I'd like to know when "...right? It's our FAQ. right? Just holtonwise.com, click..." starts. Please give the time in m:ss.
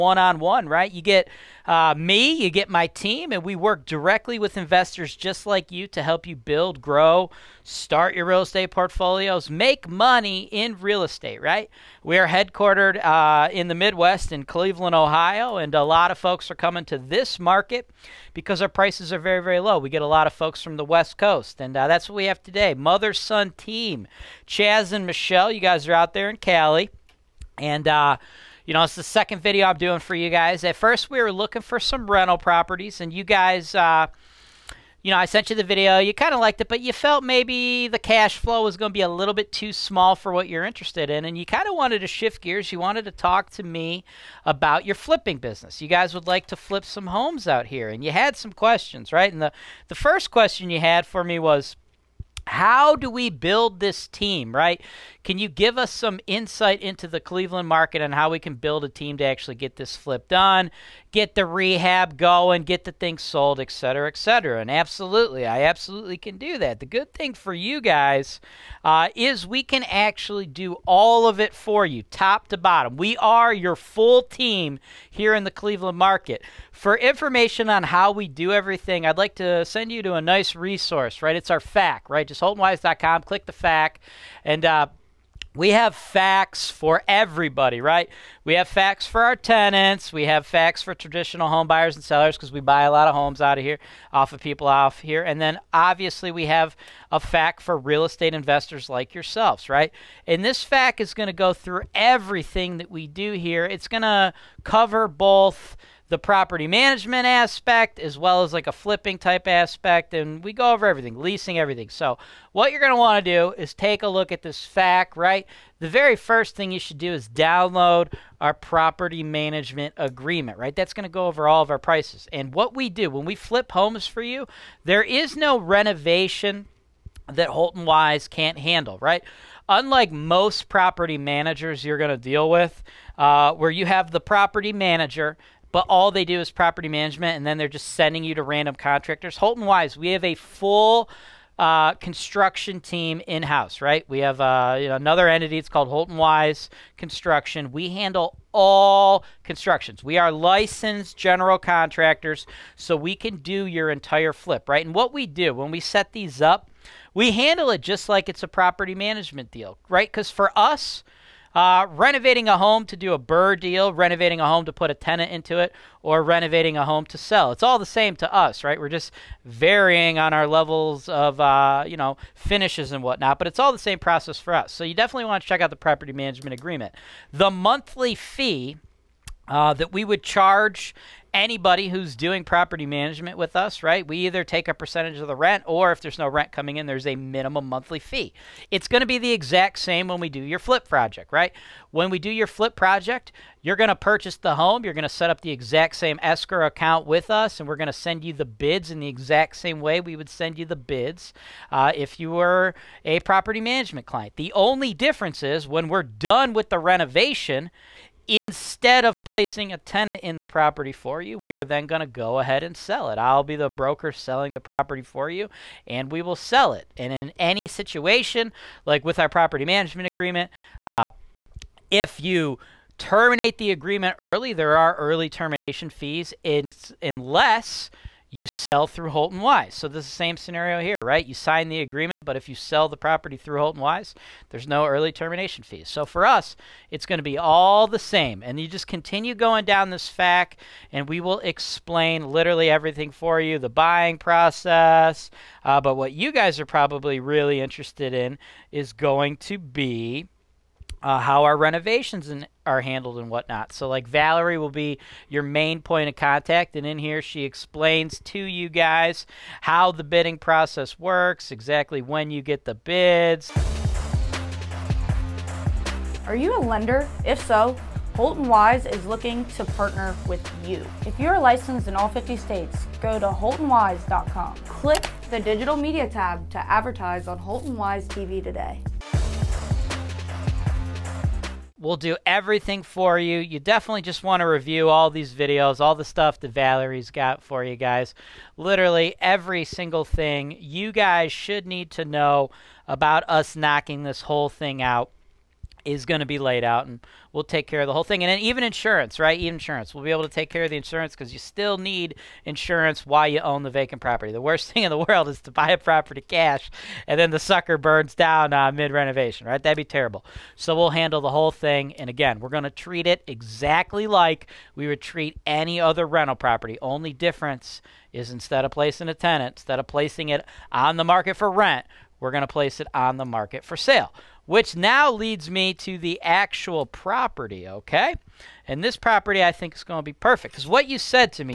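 1:21.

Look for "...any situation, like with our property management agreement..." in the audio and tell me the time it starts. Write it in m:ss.
3:37.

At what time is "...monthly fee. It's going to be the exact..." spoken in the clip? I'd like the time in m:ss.
3:07.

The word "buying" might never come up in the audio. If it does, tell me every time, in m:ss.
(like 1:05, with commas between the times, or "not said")
4:03.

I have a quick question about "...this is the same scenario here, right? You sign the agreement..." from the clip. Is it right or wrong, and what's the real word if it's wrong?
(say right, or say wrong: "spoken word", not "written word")
right.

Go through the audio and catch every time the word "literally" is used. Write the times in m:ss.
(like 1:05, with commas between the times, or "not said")
4:02, 4:48.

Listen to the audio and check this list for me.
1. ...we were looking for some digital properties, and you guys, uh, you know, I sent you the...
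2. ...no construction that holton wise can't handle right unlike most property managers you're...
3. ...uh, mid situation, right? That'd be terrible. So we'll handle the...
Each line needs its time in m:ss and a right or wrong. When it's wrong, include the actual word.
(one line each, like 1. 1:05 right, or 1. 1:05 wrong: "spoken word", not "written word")
1. 0:31 wrong: "rental", not "digital"
2. 2:05 wrong: "renovation", not "construction"
3. 5:08 wrong: "renovation", not "situation".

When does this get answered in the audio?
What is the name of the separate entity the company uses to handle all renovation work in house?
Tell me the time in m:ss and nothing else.
2:25.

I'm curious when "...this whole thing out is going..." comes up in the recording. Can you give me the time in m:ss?
4:54.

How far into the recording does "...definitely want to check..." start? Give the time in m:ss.
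2:54.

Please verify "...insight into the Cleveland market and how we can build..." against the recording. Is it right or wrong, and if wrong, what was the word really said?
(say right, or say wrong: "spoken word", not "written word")
right.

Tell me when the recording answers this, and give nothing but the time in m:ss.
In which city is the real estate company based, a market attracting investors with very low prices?
0:14.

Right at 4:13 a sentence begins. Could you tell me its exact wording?
So, like, Valerie will be your main point of contact.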